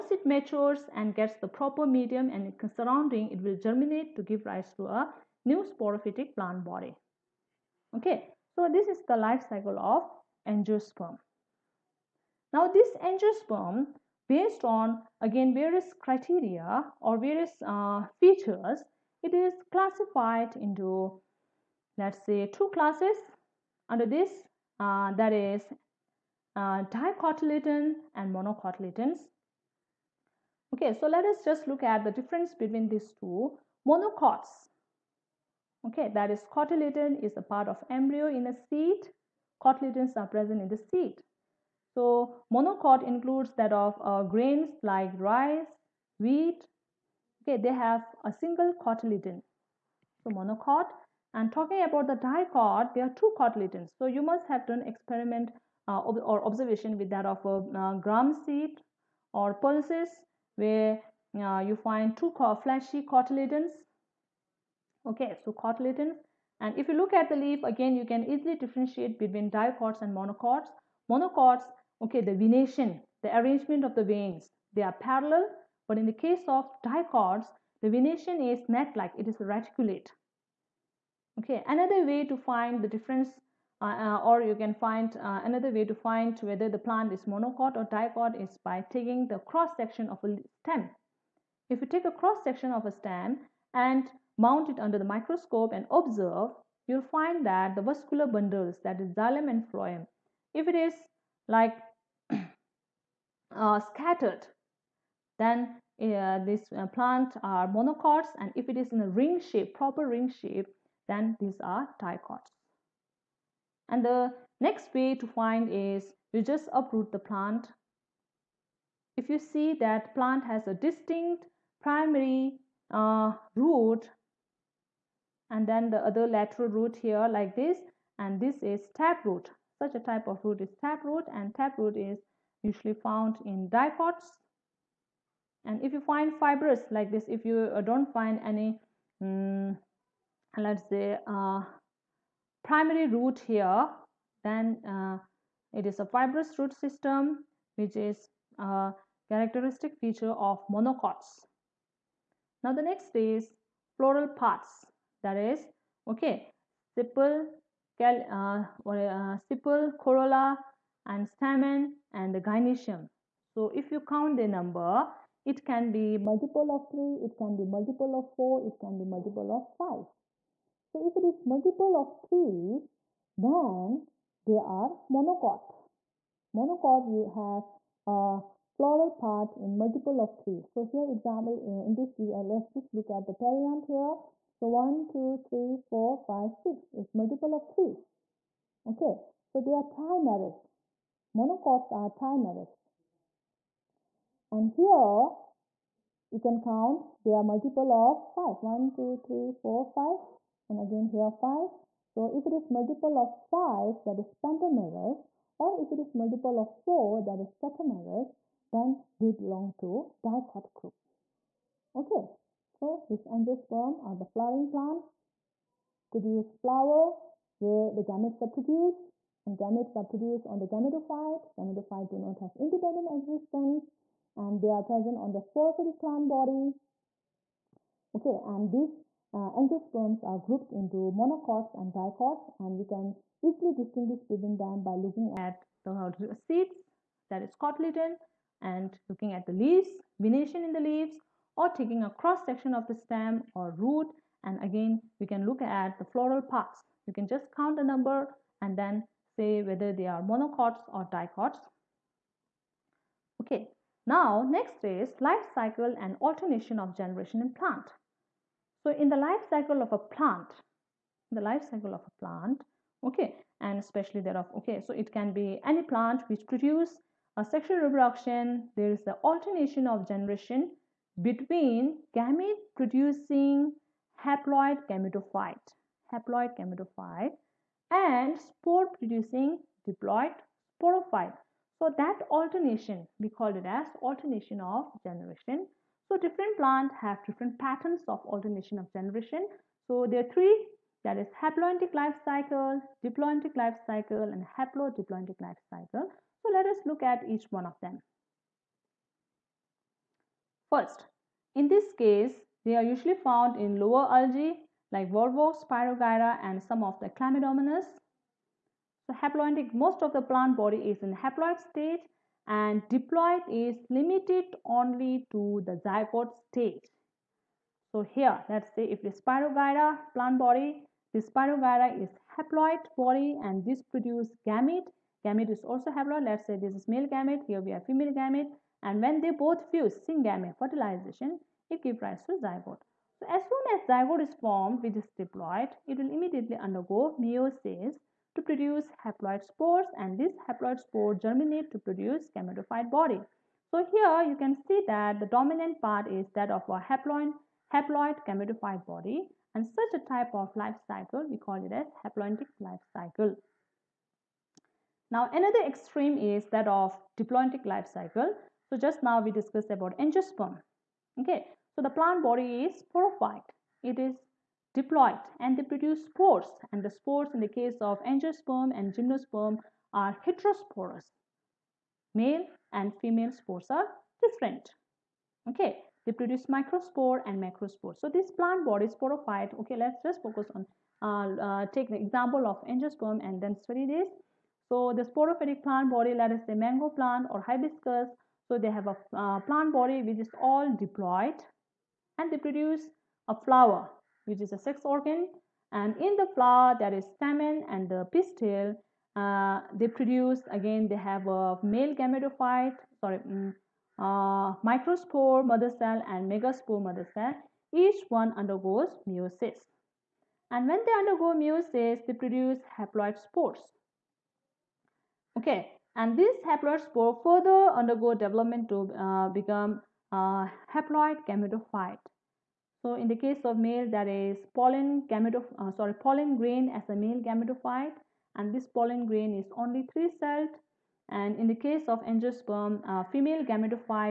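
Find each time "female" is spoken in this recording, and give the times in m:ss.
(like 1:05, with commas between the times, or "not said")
5:27, 6:12, 7:13.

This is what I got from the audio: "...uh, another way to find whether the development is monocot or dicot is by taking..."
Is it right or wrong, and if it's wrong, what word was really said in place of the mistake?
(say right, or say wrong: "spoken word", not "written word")
wrong: "plant", not "development".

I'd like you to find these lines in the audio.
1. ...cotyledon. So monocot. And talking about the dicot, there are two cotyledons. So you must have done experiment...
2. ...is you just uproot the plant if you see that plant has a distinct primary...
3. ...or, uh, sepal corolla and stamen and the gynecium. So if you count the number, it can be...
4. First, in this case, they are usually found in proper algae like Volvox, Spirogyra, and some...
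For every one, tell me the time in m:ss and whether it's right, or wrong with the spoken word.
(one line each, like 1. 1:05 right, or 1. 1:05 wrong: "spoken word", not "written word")
1. 0:48 right
2. 1:55 right
3. 2:38 right
4. 5:00 wrong: "lower", not "proper".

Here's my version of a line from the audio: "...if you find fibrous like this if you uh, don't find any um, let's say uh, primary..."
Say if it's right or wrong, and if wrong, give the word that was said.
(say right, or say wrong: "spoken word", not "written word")
right.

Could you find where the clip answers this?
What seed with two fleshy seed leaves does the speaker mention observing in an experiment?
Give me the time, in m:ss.
0:57.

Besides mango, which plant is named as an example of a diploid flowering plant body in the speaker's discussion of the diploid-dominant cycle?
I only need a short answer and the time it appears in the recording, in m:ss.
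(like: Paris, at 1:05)
hibiscus, at 6:27.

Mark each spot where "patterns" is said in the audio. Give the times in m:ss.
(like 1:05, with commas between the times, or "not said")
4:47.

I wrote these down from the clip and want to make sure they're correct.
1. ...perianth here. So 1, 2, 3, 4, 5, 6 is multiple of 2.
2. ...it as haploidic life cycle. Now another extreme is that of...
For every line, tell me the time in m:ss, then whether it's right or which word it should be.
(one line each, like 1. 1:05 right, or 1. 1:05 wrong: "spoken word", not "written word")
1. 3:03 wrong: "3", not "2"
2. 5:51 right.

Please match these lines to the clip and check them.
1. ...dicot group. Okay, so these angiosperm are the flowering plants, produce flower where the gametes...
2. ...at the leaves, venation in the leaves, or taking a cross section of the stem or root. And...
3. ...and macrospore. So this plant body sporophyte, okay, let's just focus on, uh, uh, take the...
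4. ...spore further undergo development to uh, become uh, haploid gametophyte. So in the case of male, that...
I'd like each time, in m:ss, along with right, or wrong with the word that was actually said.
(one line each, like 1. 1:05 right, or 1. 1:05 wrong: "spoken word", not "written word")
1. 3:30 right
2. 3:59 right
3. 6:17 right
4. 6:56 right.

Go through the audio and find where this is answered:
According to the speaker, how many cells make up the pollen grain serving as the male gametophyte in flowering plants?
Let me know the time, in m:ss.
7:09.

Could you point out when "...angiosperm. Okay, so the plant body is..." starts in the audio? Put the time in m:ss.
5:59.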